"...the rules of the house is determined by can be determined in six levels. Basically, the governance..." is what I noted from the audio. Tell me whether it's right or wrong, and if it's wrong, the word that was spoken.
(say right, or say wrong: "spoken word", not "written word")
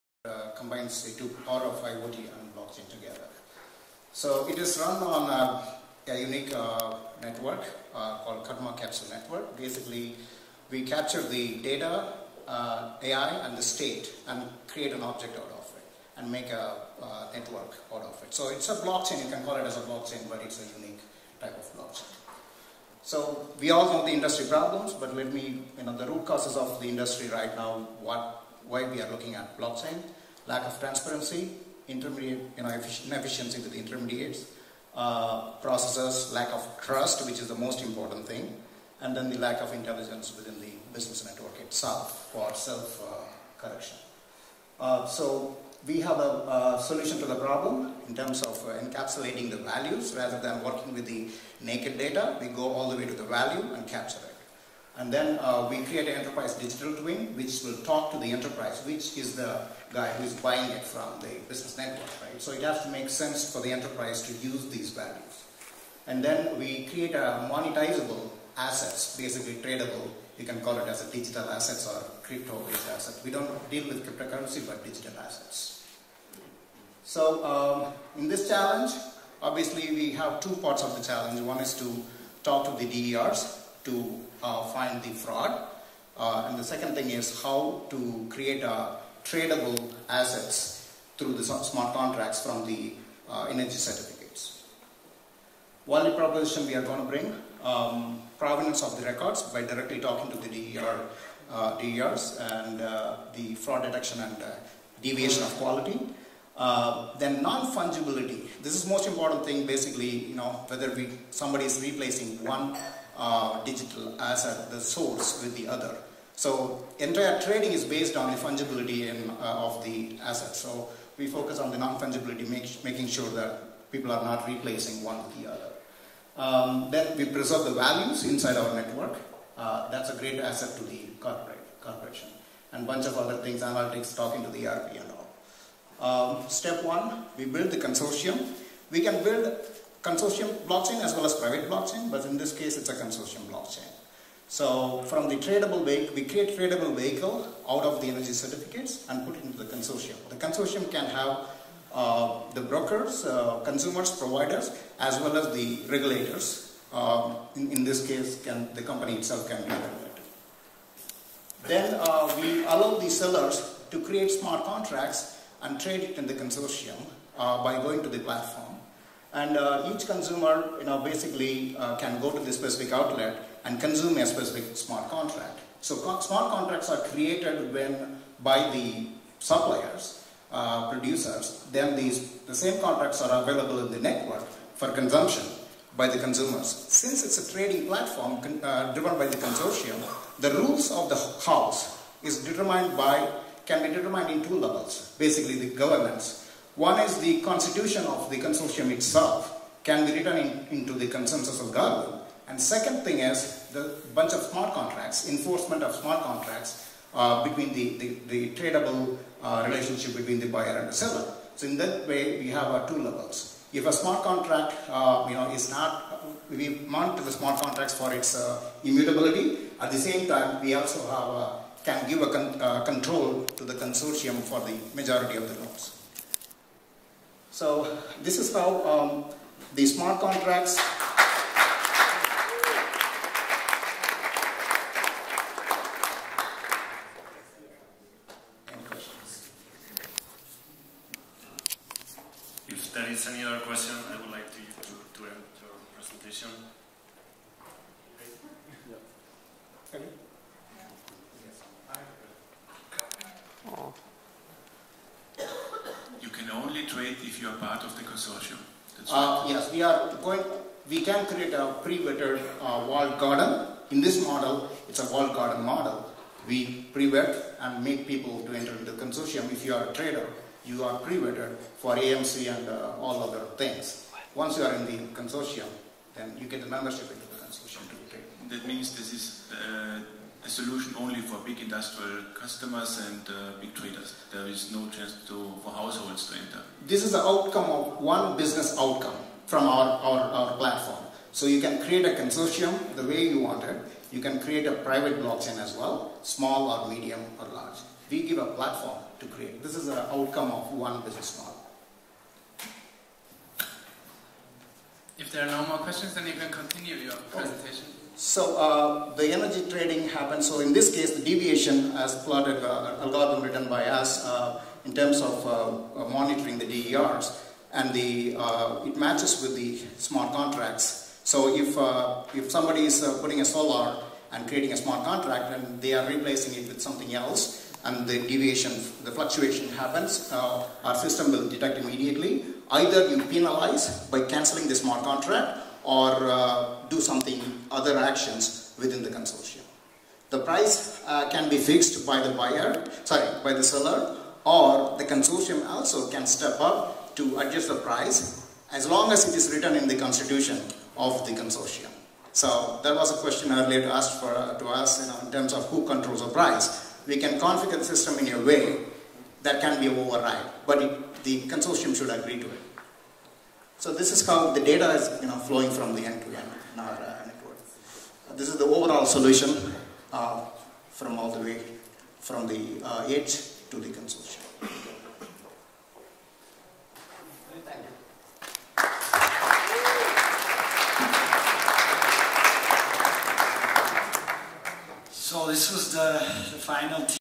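wrong: "two", not "six".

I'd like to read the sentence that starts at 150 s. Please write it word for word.
The consortium can have uh, the brokers, uh, consumers, providers, as well as the regulators.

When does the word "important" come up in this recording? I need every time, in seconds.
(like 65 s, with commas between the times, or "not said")
37 s, 109 s.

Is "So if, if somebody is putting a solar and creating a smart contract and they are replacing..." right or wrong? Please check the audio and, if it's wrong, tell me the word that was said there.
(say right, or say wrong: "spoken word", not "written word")
right.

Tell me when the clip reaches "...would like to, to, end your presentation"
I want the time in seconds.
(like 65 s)
244 s.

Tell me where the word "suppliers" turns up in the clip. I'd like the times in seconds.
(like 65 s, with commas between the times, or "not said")
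179 s.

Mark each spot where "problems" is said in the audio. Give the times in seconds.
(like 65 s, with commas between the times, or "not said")
24 s, 47 s.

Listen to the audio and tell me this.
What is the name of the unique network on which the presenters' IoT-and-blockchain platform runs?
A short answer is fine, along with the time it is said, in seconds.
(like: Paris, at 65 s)
Karma Capsule Network, at 8 s.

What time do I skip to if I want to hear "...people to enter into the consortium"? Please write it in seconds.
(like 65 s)
268 s.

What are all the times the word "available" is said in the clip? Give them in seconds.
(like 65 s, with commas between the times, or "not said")
183 s.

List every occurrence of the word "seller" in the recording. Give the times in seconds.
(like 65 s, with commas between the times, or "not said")
163 s, 210 s, 343 s.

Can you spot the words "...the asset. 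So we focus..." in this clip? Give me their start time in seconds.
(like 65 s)
119 s.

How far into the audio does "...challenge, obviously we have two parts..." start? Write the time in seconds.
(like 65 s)
78 s.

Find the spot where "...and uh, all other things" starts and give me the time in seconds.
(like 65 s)
272 s.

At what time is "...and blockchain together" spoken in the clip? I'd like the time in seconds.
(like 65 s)
2 s.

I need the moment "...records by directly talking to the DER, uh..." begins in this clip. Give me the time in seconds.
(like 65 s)
99 s.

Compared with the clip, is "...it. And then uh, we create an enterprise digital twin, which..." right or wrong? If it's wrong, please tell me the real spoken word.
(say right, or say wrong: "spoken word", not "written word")
right.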